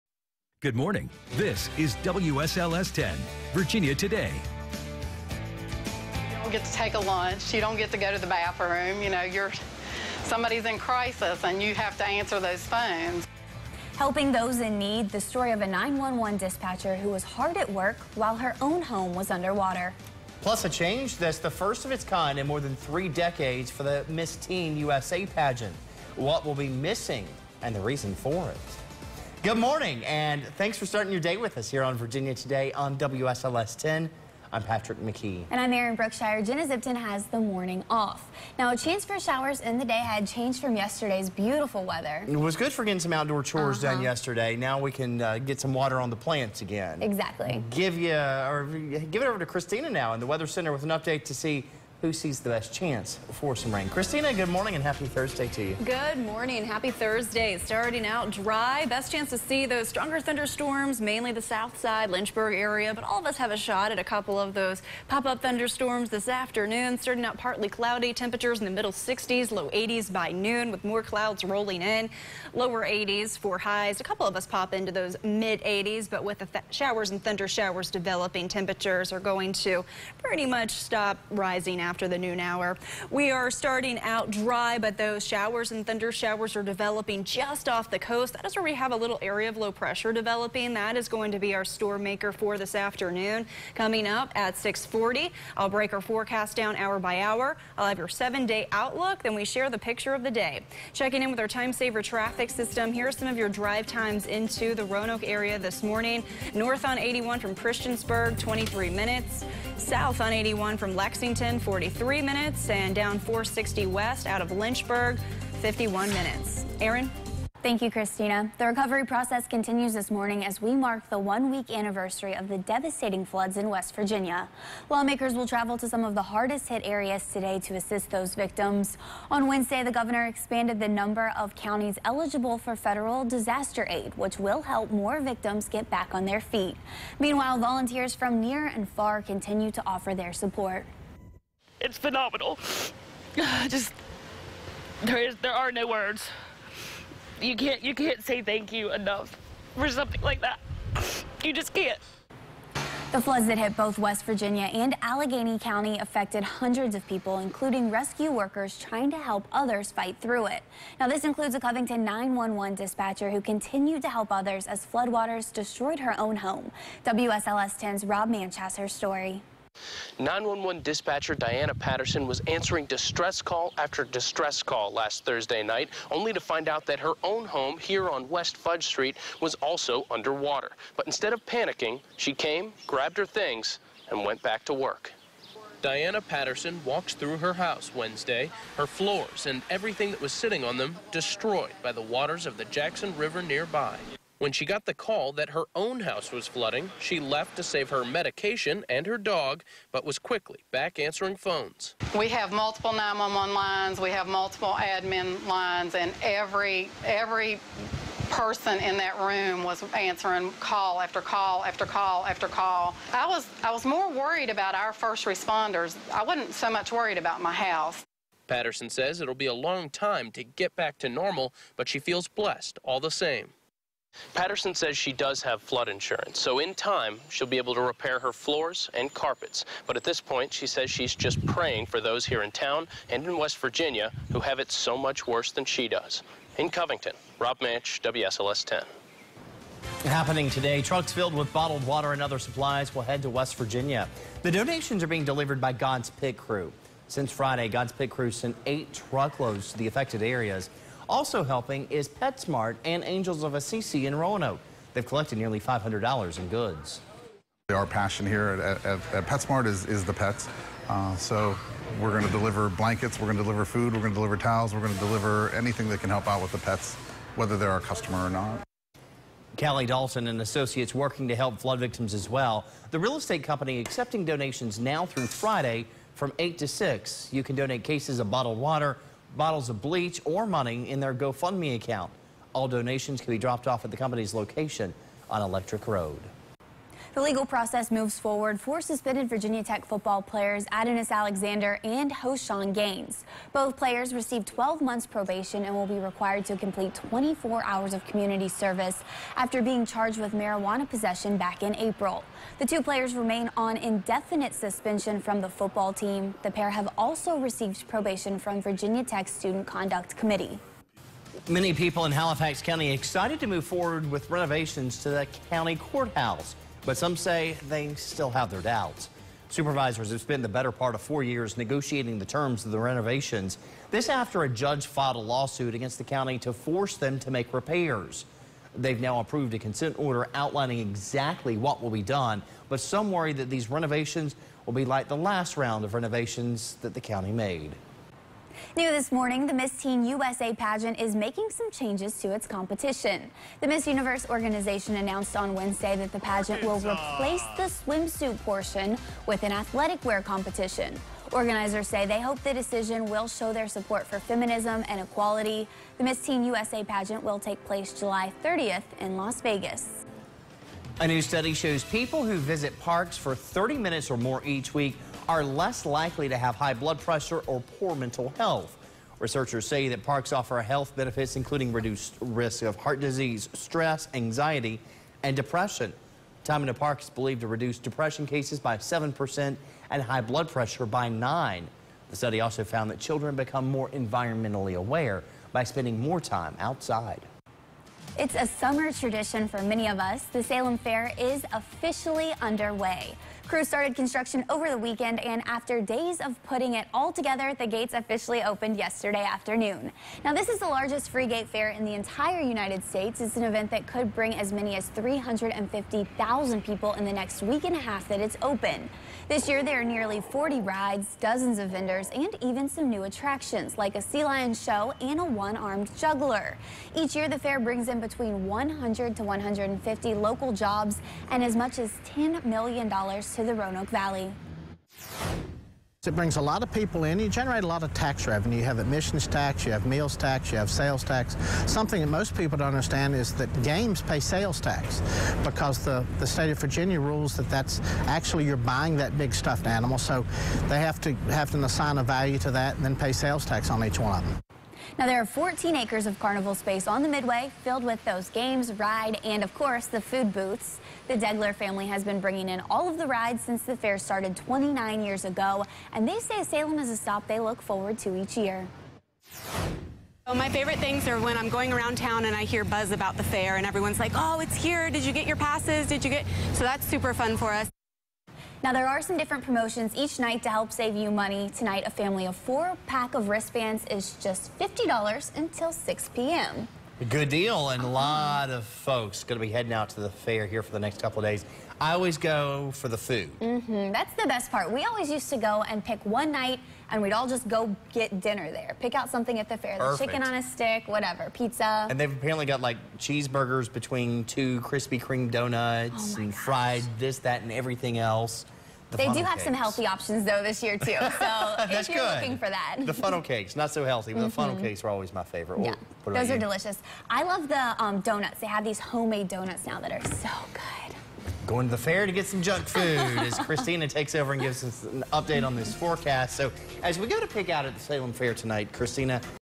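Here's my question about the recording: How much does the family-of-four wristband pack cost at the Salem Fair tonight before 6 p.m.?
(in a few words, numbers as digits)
$50.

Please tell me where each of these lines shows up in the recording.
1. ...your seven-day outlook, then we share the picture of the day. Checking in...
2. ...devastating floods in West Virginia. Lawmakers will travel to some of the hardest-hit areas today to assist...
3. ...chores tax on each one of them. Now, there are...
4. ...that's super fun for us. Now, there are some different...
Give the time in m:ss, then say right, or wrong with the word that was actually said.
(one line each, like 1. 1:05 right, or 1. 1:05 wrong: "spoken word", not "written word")
1. 1:37 right
2. 2:02 right
3. 7:23 wrong: "sales", not "chores"
4. 7:46 right.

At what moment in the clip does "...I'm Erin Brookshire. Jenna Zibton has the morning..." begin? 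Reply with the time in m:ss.
0:35.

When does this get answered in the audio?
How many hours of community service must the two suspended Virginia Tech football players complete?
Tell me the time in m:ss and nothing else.
4:56.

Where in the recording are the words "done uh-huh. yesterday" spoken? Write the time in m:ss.
0:43.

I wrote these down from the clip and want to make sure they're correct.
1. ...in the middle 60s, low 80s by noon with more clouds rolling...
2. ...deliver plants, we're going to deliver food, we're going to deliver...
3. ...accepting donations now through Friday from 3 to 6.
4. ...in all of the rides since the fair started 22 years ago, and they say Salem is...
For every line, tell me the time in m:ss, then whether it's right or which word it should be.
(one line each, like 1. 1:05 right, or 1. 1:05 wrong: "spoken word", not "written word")
1. 1:08 right
2. 4:22 wrong: "blankets", not "plants"
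3. 4:33 wrong: "8", not "3"
4. 7:32 wrong: "29", not "22".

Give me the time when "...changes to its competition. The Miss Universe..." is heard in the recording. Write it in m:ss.
5:41.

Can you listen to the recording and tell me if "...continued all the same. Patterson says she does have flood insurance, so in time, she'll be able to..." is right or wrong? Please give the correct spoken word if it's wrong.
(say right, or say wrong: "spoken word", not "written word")
wrong: "blessed", not "continued".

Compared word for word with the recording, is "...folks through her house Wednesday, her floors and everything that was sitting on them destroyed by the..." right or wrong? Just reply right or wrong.
wrong.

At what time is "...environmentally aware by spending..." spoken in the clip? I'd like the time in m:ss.
6:23.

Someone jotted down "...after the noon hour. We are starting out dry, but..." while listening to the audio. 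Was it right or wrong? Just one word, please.
right.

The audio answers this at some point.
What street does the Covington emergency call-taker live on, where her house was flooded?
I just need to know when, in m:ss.
2:58.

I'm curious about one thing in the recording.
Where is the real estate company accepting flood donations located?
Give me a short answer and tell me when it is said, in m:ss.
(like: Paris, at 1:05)
Electric Road, at 4:45.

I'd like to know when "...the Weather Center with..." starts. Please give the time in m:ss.
0:50.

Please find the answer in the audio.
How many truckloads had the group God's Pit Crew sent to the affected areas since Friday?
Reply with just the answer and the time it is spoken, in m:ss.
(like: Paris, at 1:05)
8, at 4:08.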